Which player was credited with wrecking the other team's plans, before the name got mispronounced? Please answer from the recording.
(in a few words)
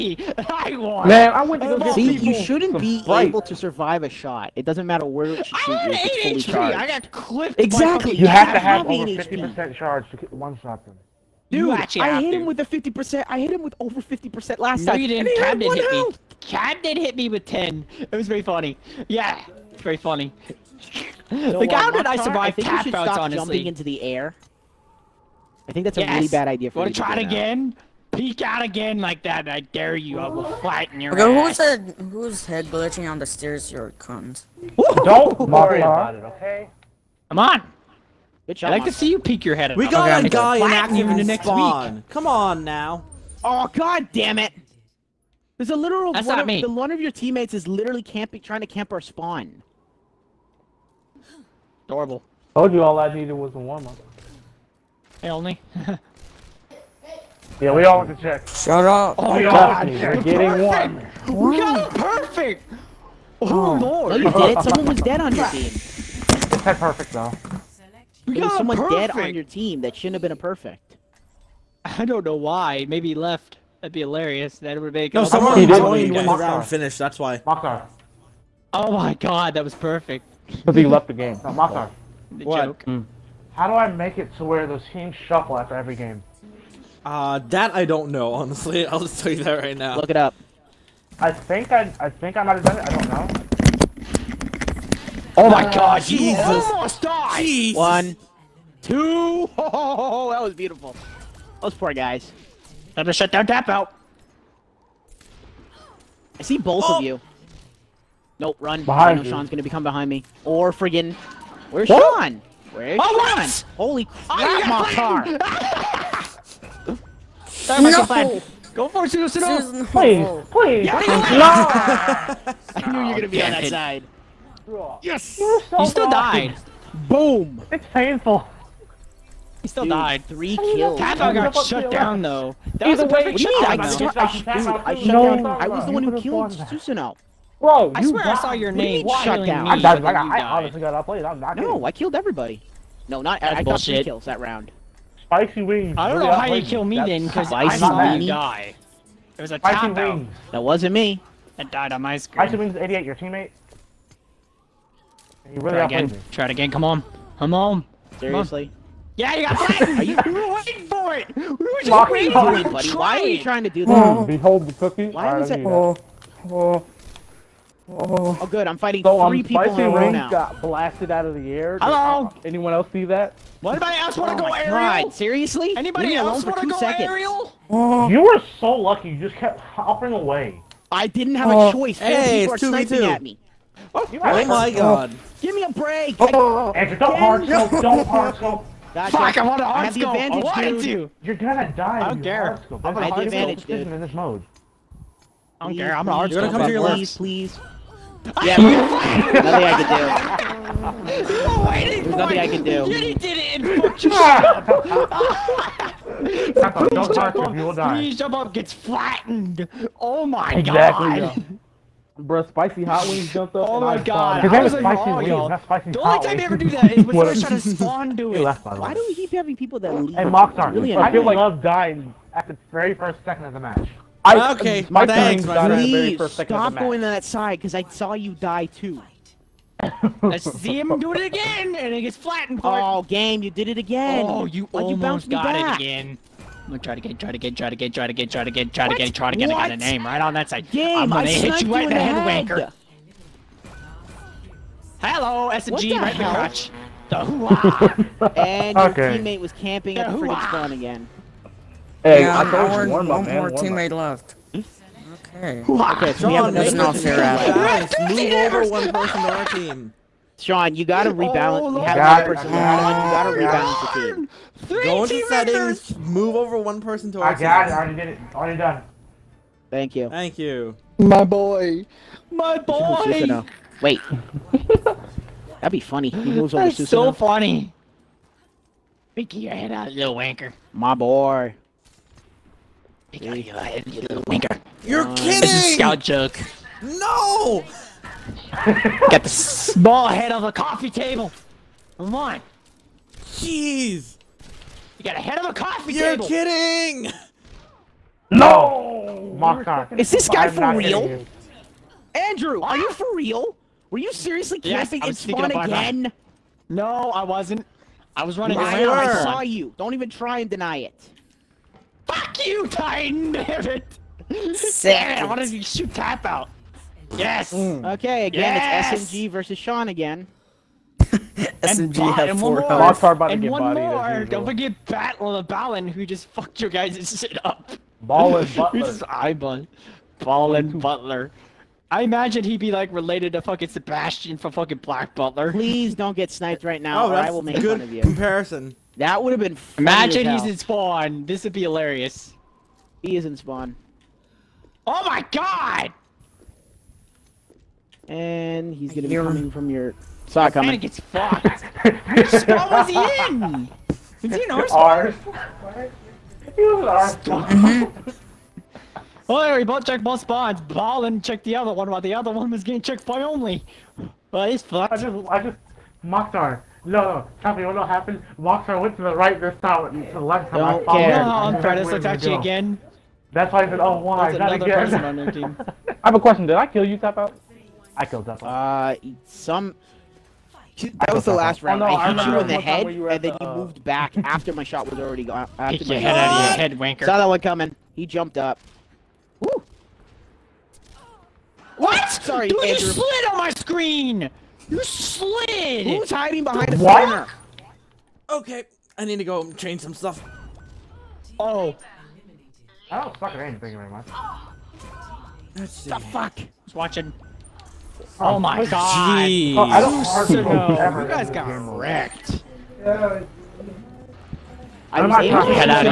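Battle of Ballin.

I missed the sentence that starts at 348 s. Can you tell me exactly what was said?
And he's gonna be coming from your...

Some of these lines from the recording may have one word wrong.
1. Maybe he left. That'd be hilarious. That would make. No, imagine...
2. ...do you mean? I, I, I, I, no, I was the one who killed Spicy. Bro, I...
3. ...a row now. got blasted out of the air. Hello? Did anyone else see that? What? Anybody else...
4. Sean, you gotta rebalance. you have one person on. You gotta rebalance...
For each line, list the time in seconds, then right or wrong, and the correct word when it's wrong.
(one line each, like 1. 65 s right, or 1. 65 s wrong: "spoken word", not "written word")
1. 72 s wrong: "someone", not "imagine"
2. 133 s wrong: "Susano", not "Spicy"
3. 169 s right
4. 260 s right.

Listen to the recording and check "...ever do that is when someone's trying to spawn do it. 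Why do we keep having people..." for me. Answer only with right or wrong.
right.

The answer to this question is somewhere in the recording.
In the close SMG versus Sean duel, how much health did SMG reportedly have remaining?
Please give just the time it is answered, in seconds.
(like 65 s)
322 s.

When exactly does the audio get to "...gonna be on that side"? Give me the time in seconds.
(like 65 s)
123 s.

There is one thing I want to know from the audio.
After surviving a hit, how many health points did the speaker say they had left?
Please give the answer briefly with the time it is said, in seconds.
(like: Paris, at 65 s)
8 HP, at 5 s.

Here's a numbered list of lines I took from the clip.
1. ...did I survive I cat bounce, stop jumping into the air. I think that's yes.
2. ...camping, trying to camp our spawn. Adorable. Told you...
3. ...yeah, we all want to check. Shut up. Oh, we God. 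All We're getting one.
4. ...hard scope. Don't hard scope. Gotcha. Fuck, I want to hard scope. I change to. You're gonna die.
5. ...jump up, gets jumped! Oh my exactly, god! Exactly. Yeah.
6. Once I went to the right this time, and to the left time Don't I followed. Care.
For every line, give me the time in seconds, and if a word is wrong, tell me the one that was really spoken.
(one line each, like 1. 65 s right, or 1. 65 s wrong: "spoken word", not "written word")
1. 21 s right
2. 48 s right
3. 57 s right
4. 187 s wrong: "advantage", not "change"
5. 208 s wrong: "flattened", not "jumped"
6. 368 s right.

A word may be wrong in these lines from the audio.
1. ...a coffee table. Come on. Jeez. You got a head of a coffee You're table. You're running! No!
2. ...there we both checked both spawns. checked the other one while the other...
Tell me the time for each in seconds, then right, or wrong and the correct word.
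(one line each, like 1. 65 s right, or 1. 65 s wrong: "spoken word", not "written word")
1. 290 s wrong: "kidding", not "running"
2. 359 s right.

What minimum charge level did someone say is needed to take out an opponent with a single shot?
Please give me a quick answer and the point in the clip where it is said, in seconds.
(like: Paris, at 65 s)
over 50%, at 8 s.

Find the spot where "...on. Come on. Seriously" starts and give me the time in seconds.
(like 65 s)
156 s.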